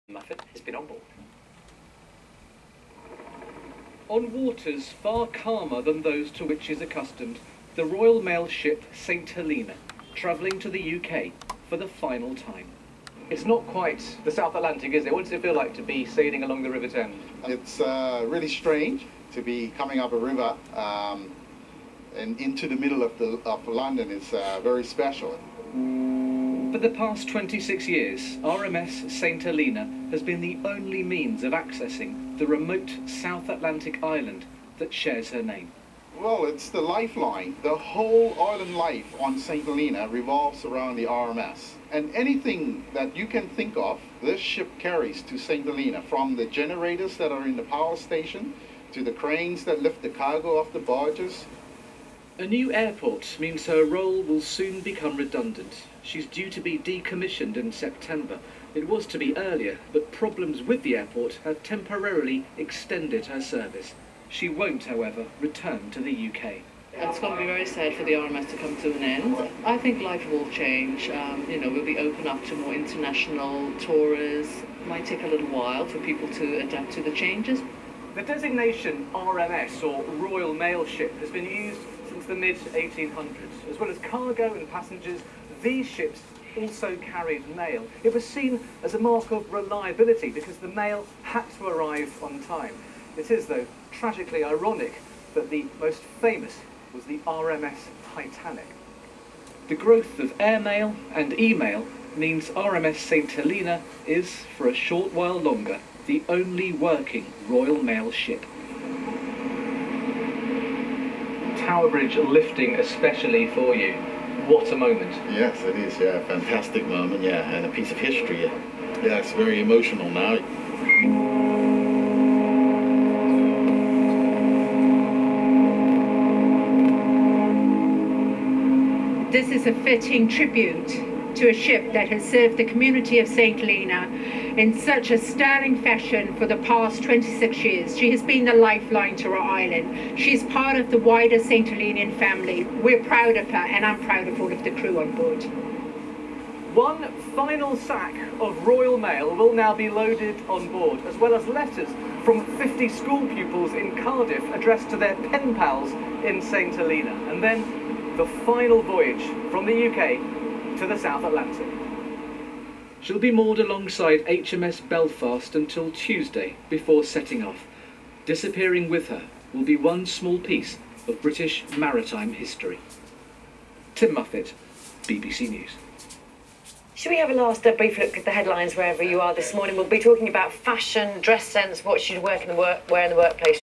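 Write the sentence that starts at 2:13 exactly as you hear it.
Helena in such a sterling fashion for the past 26 years.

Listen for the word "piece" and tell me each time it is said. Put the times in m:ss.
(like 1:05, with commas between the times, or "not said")
1:57, 2:50.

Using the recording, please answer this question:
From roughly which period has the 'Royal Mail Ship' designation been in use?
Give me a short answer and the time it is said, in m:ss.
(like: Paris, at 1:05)
mid-1800s, at 1:22.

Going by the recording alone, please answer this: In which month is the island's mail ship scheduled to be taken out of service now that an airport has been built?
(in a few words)
September.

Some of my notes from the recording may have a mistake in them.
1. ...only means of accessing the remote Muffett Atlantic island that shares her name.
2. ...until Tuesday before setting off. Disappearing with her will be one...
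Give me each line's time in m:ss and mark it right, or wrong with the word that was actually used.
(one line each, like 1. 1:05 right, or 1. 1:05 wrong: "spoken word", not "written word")
1. 0:30 wrong: "South", not "Muffett"
2. 2:45 right.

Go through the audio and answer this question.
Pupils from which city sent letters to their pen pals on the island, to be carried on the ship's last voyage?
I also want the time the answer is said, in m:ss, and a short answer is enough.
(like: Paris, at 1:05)
Cardiff, at 2:34.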